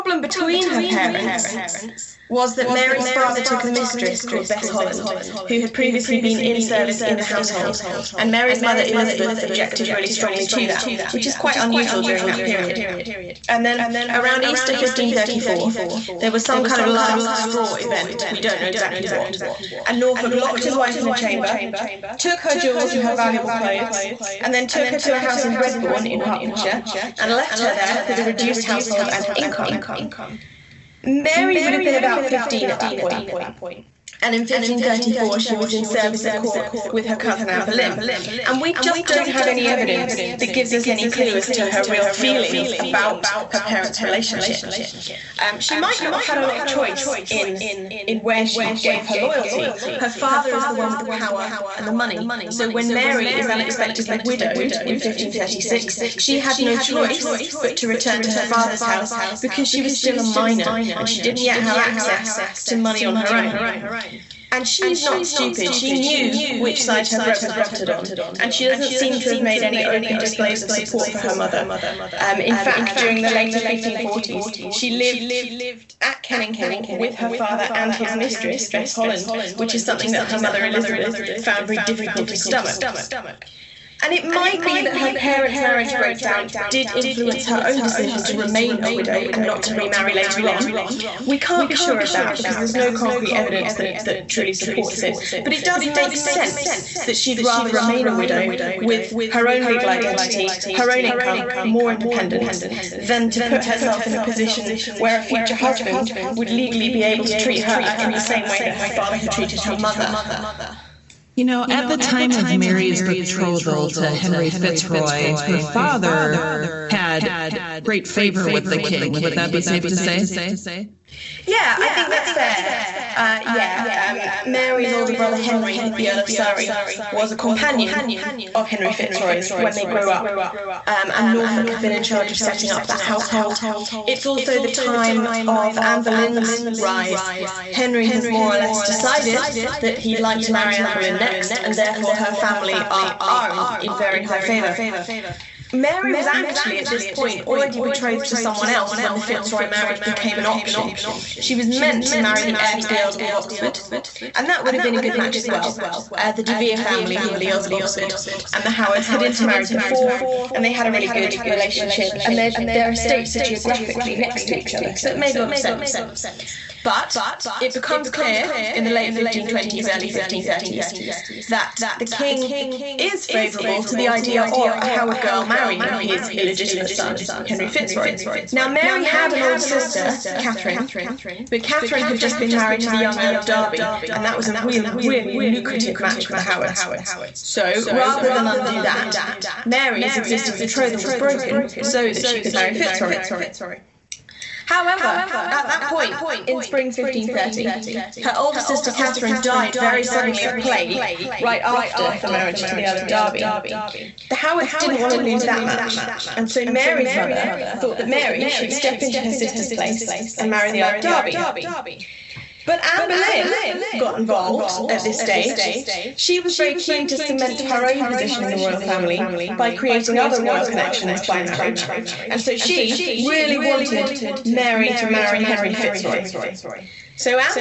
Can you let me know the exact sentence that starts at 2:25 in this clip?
Mary was actually at this point already betrothed to someone else when the Fitzroy marriage became an option.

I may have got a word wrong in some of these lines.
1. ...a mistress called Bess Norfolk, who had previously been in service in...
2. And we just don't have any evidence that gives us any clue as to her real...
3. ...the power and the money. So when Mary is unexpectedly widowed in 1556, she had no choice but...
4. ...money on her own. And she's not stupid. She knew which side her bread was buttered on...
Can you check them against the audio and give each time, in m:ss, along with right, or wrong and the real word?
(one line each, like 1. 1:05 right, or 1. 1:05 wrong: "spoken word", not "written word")
1. 0:03 wrong: "Holland", not "Norfolk"
2. 0:38 right
3. 0:50 wrong: "1536", not "1556"
4. 1:02 right.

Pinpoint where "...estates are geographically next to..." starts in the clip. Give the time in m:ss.
2:42.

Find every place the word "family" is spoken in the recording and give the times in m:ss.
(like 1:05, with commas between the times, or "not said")
2:22, 2:36, 3:38.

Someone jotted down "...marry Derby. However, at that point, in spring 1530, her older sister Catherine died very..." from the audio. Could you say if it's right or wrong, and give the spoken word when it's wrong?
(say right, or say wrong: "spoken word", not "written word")
wrong: "Fitzroy", not "Derby".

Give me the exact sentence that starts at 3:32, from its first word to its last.
But Anne Boleyn got involved at this stage.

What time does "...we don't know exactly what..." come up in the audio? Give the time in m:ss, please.
0:18.